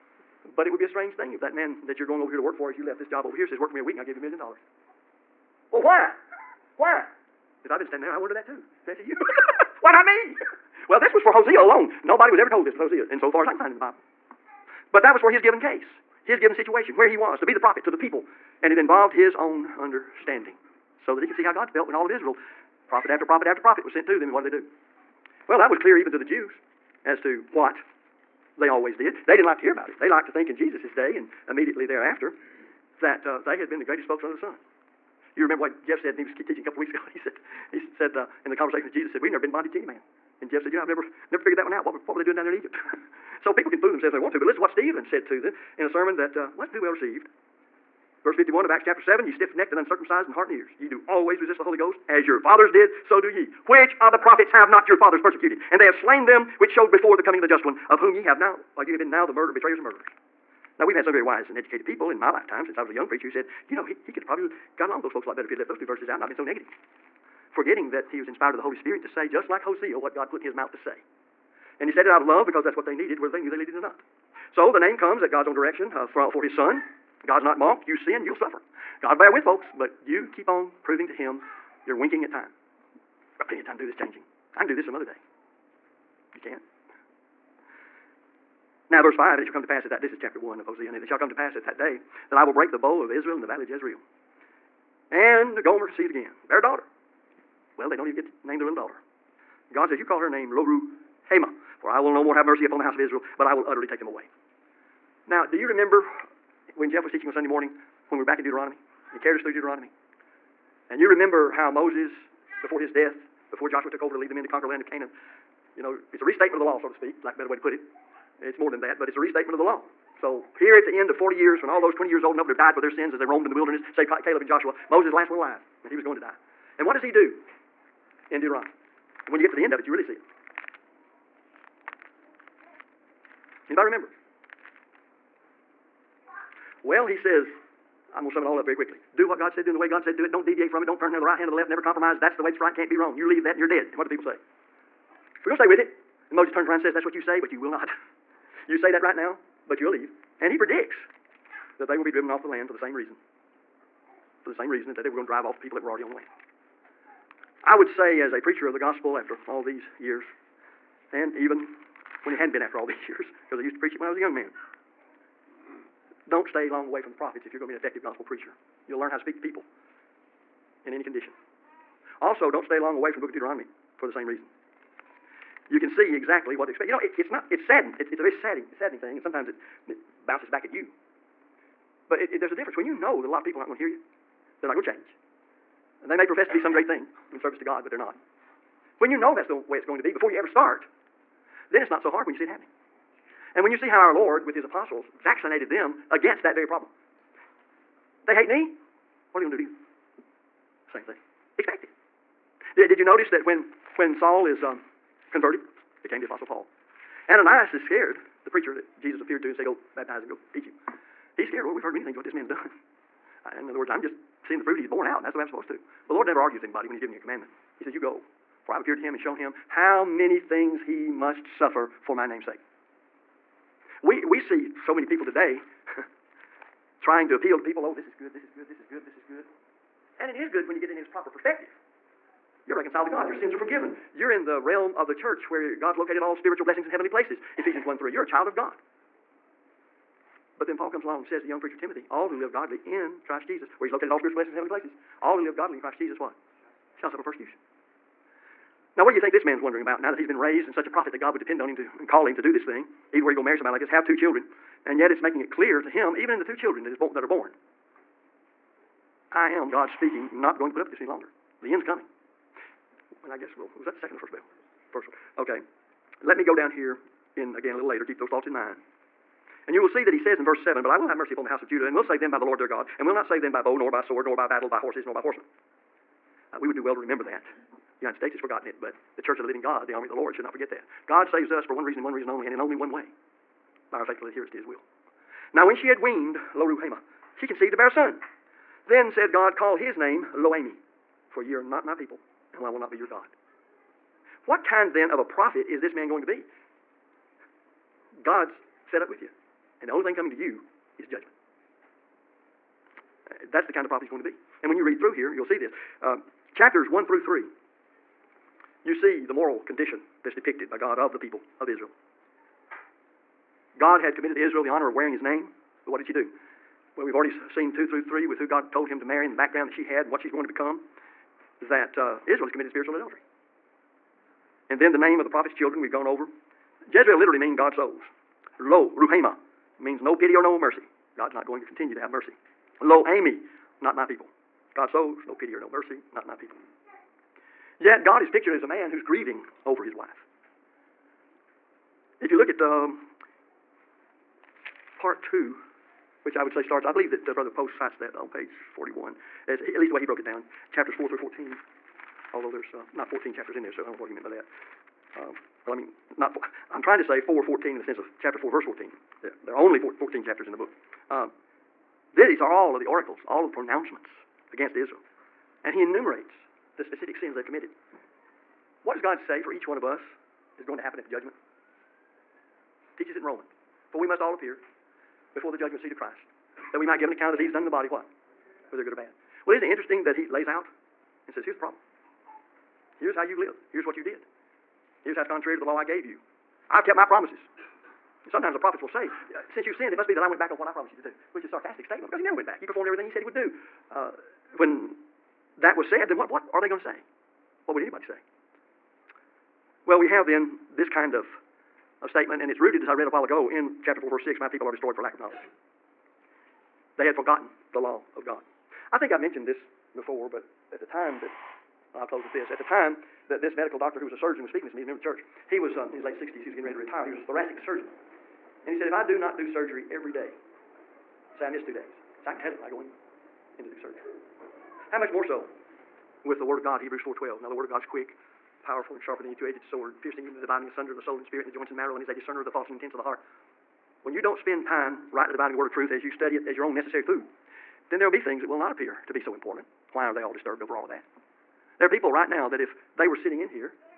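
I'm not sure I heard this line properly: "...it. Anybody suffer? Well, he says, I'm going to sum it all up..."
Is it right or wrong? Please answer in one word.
wrong.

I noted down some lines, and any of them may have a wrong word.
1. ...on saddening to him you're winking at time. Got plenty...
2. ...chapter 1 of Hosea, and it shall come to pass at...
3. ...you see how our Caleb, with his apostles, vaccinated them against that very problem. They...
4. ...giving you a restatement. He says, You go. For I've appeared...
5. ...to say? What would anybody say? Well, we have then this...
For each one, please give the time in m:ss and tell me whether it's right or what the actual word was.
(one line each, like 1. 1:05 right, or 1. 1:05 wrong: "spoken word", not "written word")
1. 1:20 wrong: "proving", not "saddening"
2. 1:30 right
3. 3:13 wrong: "Lord", not "Caleb"
4. 3:36 wrong: "commandment", not "restatement"
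5. 6:36 right.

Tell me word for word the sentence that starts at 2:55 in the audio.
You can see exactly what to expect.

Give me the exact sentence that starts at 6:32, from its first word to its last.
He performed everything he said he would do.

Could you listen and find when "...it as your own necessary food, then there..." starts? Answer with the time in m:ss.
7:16.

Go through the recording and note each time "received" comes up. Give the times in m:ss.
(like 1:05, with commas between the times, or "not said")
0:46.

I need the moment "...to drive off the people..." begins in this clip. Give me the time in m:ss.
2:35.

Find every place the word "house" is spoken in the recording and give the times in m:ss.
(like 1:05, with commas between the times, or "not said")
1:42, 4:31.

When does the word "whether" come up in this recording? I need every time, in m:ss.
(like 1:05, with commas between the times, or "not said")
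1:13, 6:18.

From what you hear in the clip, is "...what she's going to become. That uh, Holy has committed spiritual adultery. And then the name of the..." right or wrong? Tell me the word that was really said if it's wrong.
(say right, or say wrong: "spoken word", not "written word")
wrong: "Israel", not "Holy".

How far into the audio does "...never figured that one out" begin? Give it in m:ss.
0:41.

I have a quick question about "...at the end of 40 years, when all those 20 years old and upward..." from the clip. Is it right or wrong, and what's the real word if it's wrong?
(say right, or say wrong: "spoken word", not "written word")
right.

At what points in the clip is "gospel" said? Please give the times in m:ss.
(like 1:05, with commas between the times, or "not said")
2:38, 2:48.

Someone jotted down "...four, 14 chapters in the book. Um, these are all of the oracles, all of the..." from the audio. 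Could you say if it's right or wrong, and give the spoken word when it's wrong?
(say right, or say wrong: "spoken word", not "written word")
right.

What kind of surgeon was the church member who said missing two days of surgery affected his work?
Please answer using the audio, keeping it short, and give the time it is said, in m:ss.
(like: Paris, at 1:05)
Thoracic surgeon, at 6:57.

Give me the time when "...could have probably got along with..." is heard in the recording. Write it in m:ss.
1:04.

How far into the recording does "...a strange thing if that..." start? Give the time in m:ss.
0:00.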